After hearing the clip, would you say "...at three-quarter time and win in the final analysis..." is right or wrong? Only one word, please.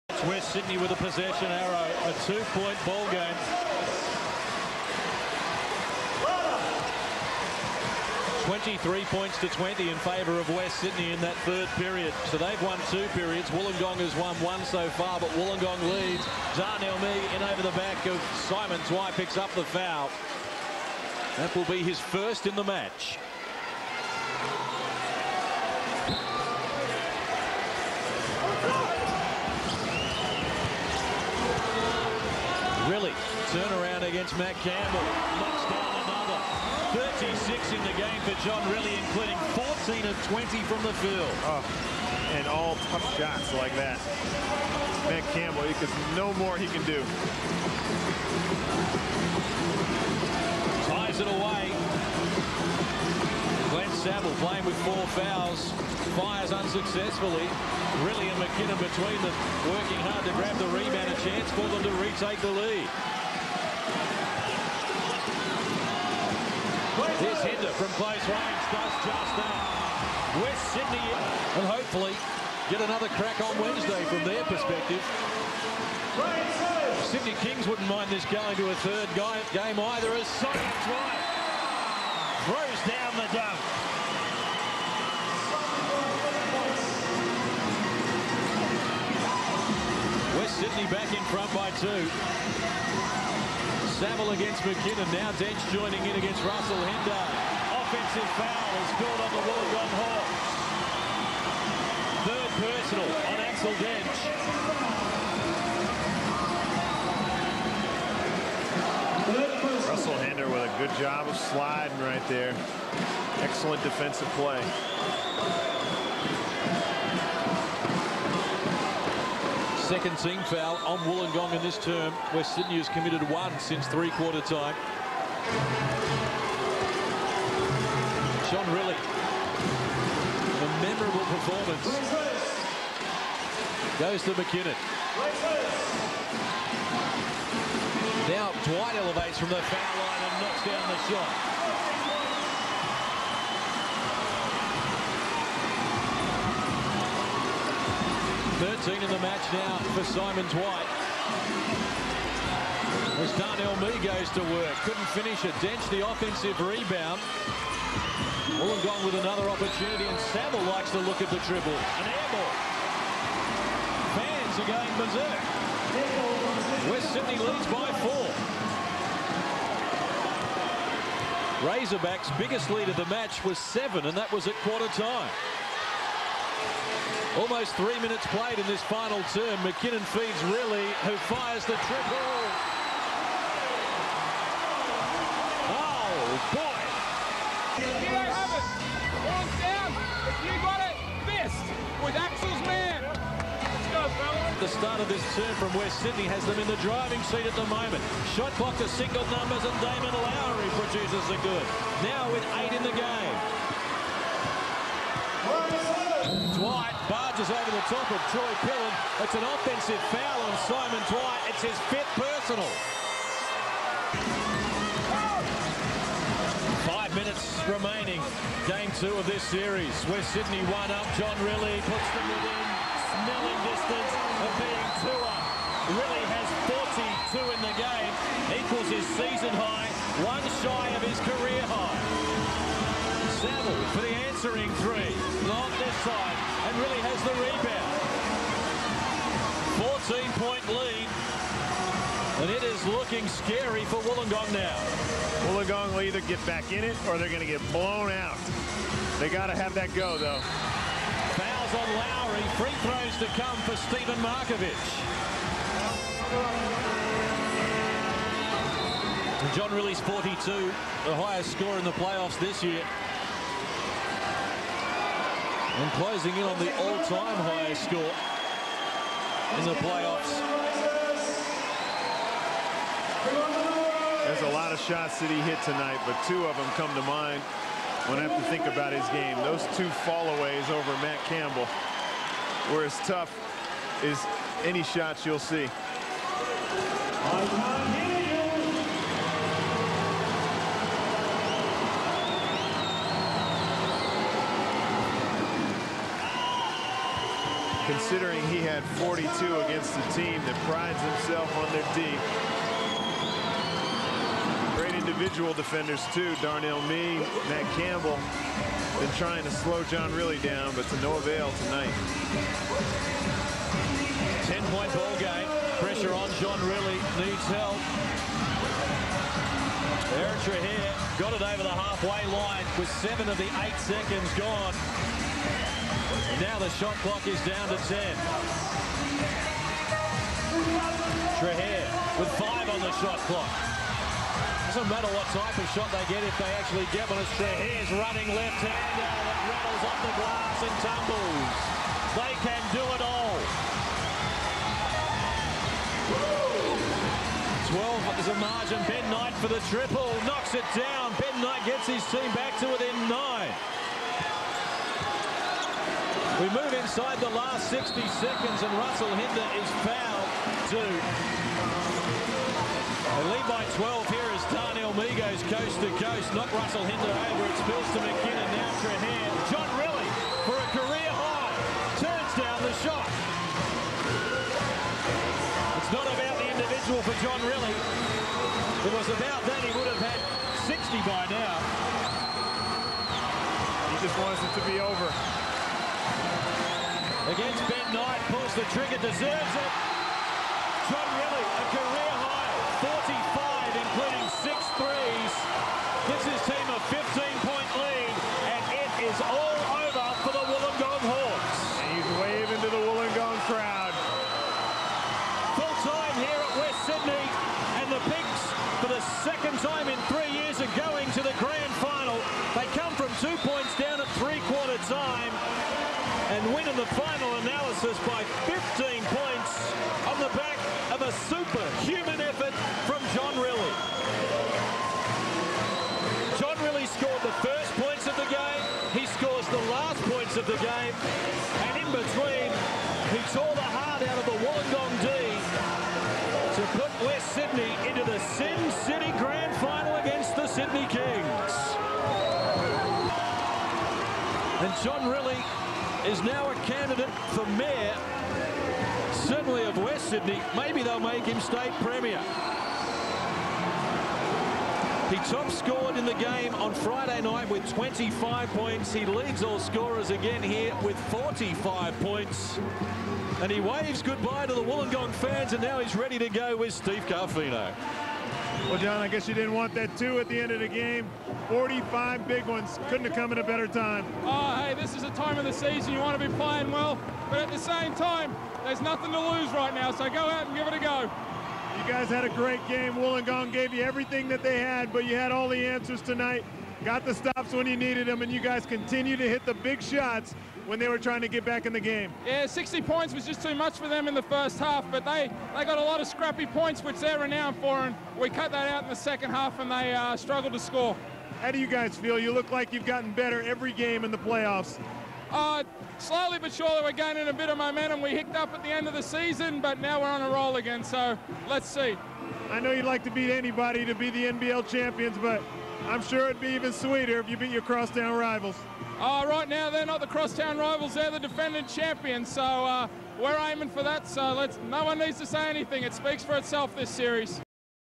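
right.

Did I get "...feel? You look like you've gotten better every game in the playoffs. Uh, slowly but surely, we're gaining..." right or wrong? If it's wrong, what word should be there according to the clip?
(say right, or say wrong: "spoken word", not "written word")
right.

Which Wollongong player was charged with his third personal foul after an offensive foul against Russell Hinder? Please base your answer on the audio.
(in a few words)
Axel Dench.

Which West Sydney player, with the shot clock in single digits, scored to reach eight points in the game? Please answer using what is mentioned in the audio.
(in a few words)
Damon Lowry.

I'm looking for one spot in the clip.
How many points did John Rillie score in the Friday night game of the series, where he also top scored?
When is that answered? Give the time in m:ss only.
7:37.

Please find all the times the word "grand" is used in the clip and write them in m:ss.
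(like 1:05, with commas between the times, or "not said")
6:51, 7:19.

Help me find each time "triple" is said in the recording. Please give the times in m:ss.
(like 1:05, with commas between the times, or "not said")
2:41, 3:01, 5:49.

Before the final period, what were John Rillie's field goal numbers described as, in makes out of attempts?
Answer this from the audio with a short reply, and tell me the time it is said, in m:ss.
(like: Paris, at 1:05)
14 of 20, at 0:39.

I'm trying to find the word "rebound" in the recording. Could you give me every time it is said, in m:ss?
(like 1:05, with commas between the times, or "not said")
1:00, 2:36, 4:00.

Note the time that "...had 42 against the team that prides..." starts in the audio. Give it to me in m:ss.
4:58.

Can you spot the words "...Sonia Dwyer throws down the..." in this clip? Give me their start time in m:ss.
1:20.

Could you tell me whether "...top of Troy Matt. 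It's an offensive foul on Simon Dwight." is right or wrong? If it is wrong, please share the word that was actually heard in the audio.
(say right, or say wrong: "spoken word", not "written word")
wrong: "Pillen", not "Matt".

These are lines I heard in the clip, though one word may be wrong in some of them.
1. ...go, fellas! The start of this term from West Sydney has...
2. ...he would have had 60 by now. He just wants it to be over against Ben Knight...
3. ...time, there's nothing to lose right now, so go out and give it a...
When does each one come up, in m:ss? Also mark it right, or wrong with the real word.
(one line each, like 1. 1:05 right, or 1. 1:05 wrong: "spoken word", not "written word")
1. 3:13 right
2. 6:19 right
3. 7:57 right.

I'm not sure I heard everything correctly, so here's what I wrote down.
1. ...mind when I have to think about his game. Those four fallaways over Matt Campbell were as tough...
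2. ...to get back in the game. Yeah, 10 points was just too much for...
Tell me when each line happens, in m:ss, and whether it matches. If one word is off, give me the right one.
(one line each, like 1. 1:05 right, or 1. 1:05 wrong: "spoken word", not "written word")
1. 4:37 wrong: "two", not "four"
2. 8:11 wrong: "60", not "10".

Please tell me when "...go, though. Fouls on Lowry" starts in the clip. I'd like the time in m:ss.
4:09.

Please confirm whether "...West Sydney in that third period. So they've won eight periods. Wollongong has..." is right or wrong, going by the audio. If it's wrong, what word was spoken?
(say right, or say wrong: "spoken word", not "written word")
wrong: "two", not "eight".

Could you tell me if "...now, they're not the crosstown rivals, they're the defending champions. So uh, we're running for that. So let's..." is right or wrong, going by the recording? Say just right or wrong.
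wrong.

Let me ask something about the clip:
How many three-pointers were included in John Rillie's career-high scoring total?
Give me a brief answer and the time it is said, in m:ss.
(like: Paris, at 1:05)
6, at 6:34.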